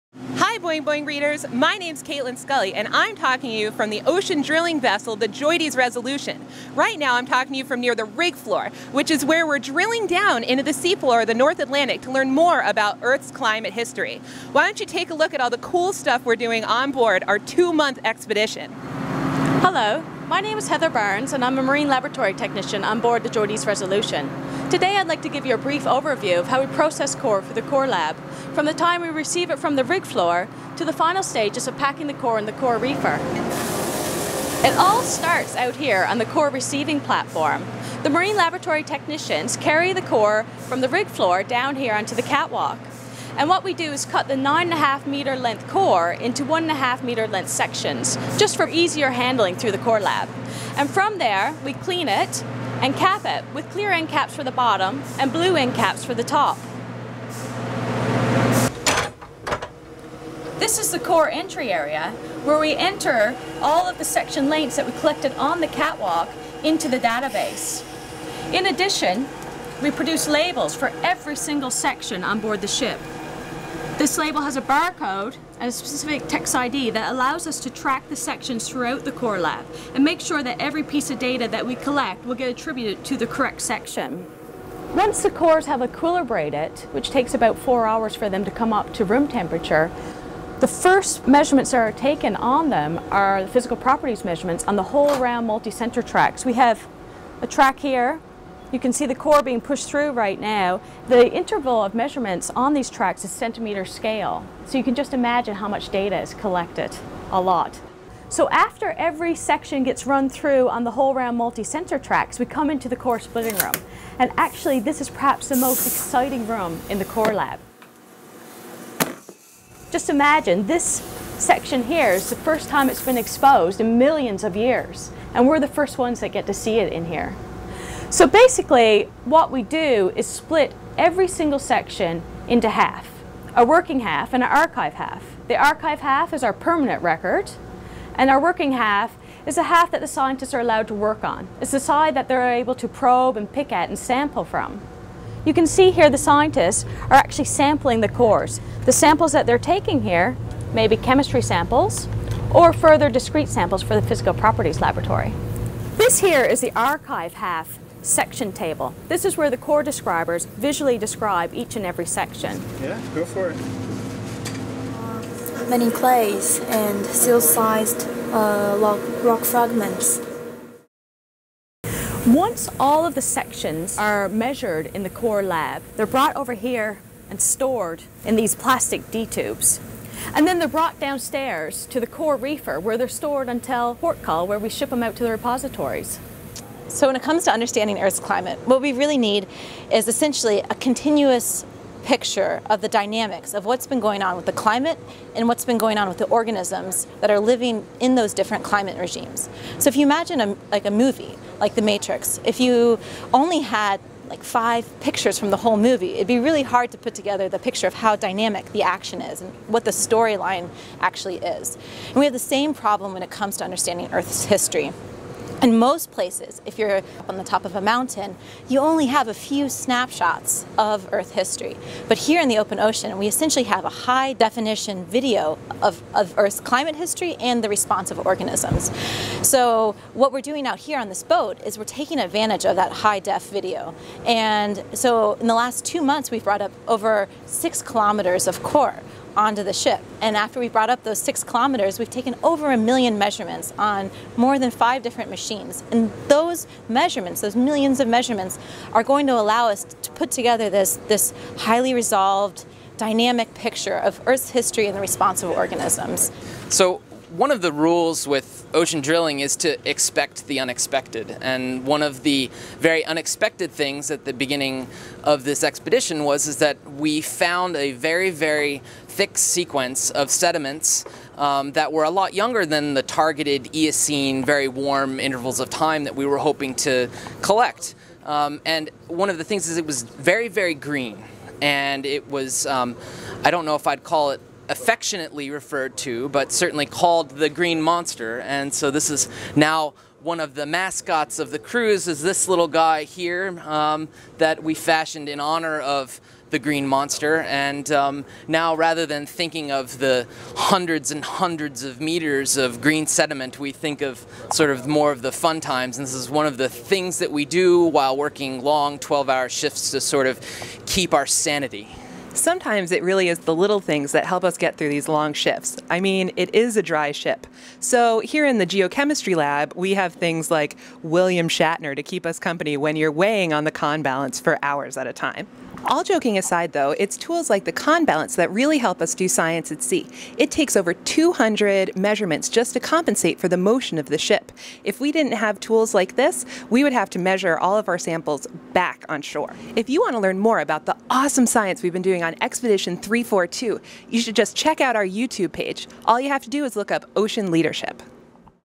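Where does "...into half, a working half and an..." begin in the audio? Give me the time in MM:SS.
02:12.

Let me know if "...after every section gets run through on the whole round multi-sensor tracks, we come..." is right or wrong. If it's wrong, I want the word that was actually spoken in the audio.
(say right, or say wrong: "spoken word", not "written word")
right.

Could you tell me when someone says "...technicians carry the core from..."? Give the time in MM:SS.
00:38.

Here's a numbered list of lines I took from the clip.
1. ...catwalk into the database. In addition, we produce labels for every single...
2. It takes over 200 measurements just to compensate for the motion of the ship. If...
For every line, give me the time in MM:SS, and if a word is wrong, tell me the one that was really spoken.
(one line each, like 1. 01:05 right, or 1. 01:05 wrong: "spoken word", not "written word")
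1. 01:05 right
2. 05:30 right.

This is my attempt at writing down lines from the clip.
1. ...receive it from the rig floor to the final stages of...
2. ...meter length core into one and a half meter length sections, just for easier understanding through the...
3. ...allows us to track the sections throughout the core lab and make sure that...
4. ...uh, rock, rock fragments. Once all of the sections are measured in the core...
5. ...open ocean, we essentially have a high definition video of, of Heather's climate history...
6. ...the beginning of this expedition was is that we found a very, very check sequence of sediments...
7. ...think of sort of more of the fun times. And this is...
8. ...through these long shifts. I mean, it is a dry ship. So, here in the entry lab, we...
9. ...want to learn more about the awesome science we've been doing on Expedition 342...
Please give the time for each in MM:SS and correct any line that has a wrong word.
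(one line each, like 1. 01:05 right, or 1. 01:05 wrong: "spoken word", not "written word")
1. 00:29 right
2. 00:45 wrong: "handling", not "understanding"
3. 01:17 right
4. 02:48 right
5. 03:42 wrong: "Earth", not "Heather"
6. 04:24 wrong: "thick", not "check"
7. 05:03 right
8. 05:14 wrong: "geochemistry", not "entry"
9. 05:40 right.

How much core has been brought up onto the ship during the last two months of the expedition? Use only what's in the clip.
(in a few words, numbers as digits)
over 6 kilometers.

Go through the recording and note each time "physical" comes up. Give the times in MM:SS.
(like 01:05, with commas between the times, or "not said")
01:33, 02:34.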